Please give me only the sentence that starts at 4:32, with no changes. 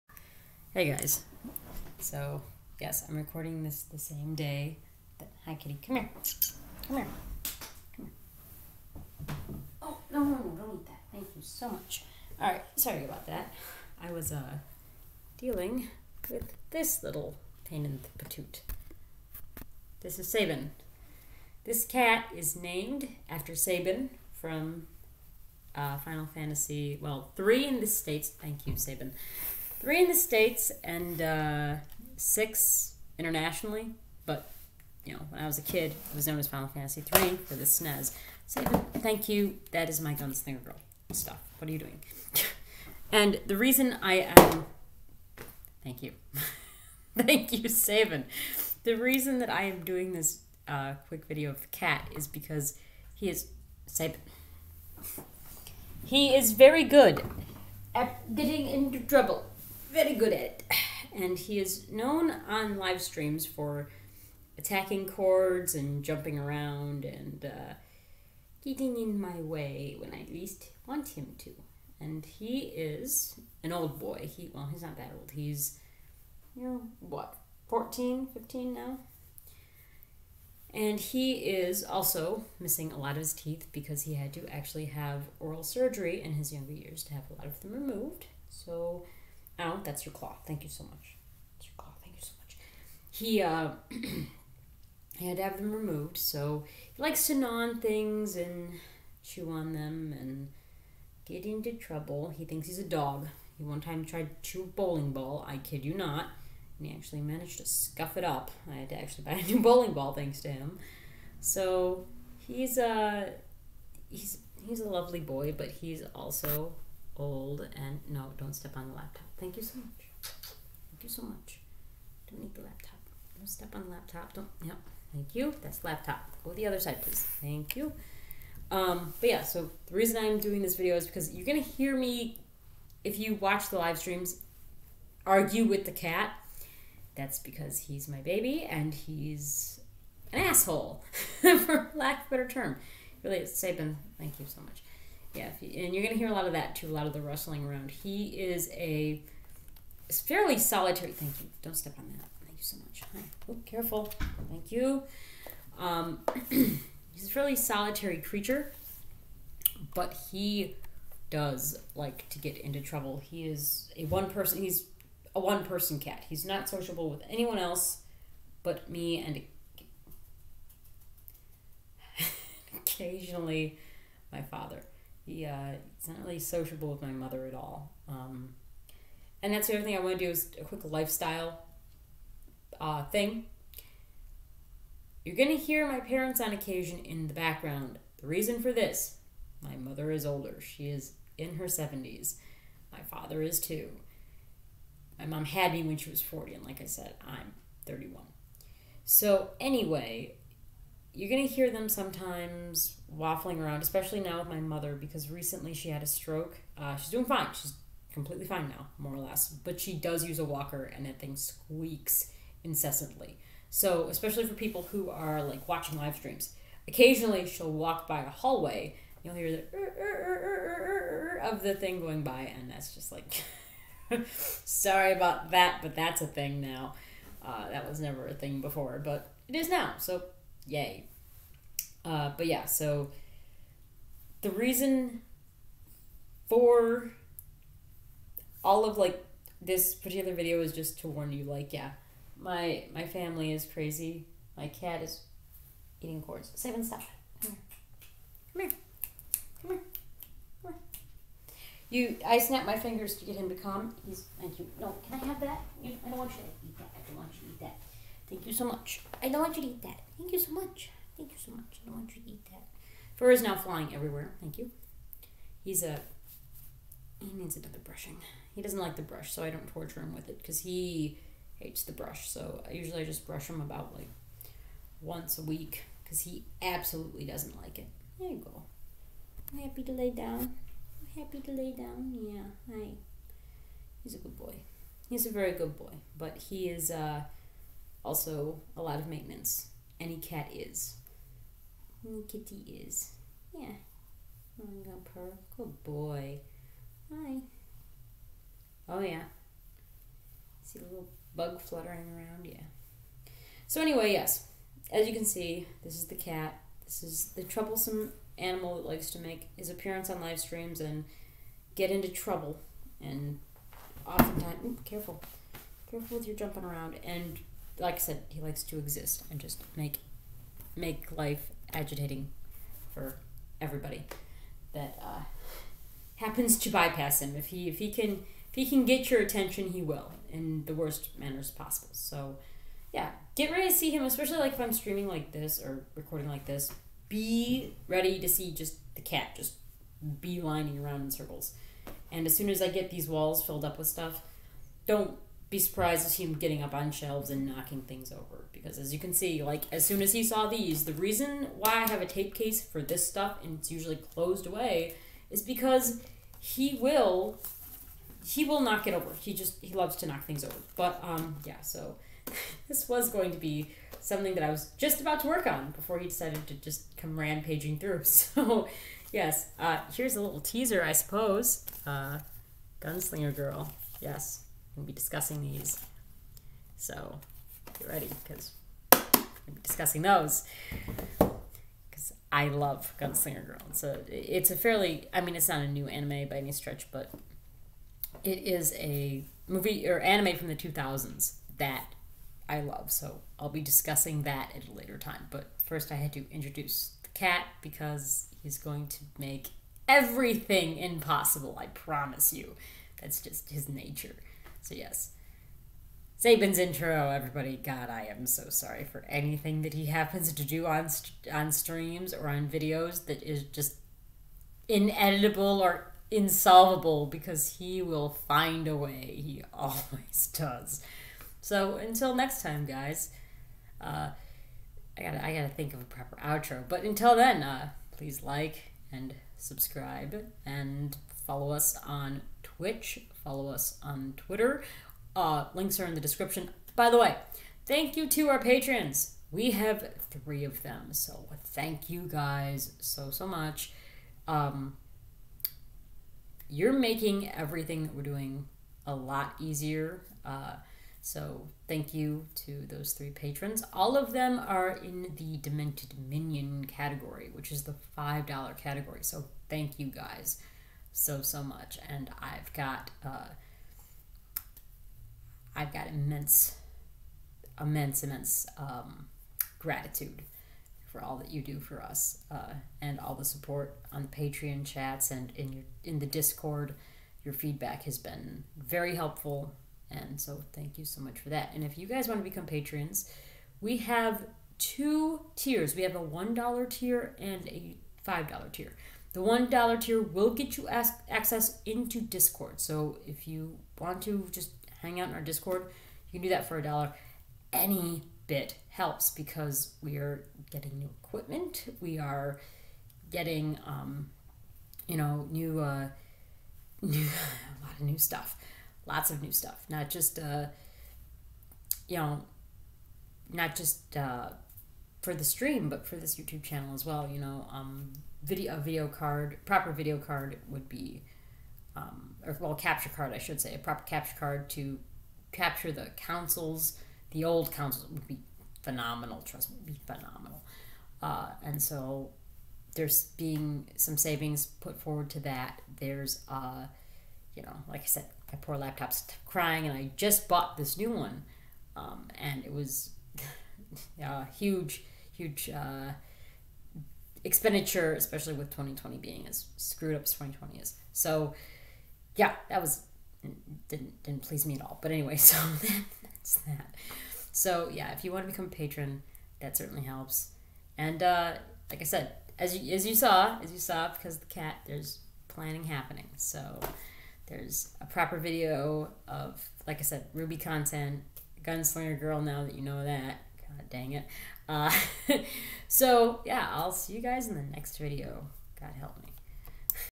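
So I uh, usually I just brush him about like once a week because he absolutely doesn't like it.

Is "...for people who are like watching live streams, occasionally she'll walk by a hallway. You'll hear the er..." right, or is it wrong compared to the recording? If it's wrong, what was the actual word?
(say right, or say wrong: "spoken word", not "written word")
right.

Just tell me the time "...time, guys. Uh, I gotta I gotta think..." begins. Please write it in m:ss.
7:02.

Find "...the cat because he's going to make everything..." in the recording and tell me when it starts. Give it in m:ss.
6:37.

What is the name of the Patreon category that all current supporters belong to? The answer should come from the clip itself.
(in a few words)
Demented Minion.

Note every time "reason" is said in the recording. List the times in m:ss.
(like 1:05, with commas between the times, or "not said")
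0:43, 0:48, 2:09, 3:08, 3:54, 5:50.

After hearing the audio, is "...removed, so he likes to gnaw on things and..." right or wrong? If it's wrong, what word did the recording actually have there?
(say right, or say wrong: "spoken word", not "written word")
right.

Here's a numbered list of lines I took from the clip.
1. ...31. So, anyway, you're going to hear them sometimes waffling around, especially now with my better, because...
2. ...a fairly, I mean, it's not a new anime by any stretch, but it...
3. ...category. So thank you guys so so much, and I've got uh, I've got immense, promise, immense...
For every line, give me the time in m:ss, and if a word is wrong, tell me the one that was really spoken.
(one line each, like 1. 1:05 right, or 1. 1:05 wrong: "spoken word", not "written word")
1. 3:17 wrong: "mother", not "better"
2. 6:24 right
3. 7:38 wrong: "immense", not "promise".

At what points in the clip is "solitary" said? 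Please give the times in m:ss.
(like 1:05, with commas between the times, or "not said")
2:30, 2:37.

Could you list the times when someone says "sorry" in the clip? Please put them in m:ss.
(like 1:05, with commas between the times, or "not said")
0:12, 3:44, 6:48.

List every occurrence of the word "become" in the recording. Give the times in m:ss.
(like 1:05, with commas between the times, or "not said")
8:02, 9:18.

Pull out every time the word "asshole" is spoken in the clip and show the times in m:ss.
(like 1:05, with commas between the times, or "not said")
2:20.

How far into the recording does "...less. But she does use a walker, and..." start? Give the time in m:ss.
3:29.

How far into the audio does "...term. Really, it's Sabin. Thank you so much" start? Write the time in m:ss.
2:22.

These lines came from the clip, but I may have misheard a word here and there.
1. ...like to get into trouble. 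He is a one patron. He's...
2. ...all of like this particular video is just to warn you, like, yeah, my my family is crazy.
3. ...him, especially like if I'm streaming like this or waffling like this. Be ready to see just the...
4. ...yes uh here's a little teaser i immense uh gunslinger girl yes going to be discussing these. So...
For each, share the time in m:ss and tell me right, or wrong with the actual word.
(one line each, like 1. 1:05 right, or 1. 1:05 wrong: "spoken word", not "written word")
1. 2:41 wrong: "person", not "patron"
2. 3:58 right
3. 5:33 wrong: "recording", not "waffling"
4. 6:09 wrong: "suppose", not "immense".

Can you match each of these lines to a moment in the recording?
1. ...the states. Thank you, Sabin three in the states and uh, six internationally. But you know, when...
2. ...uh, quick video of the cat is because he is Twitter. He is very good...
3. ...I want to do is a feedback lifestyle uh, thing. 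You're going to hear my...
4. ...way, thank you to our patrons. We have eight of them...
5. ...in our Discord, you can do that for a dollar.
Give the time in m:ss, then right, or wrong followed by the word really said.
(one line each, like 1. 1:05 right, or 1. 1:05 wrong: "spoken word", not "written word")
1. 0:27 right
2. 0:50 wrong: "Sabin", not "Twitter"
3. 2:59 wrong: "quick", not "feedback"
4. 7:16 wrong: "three", not "eight"
5. 8:15 right.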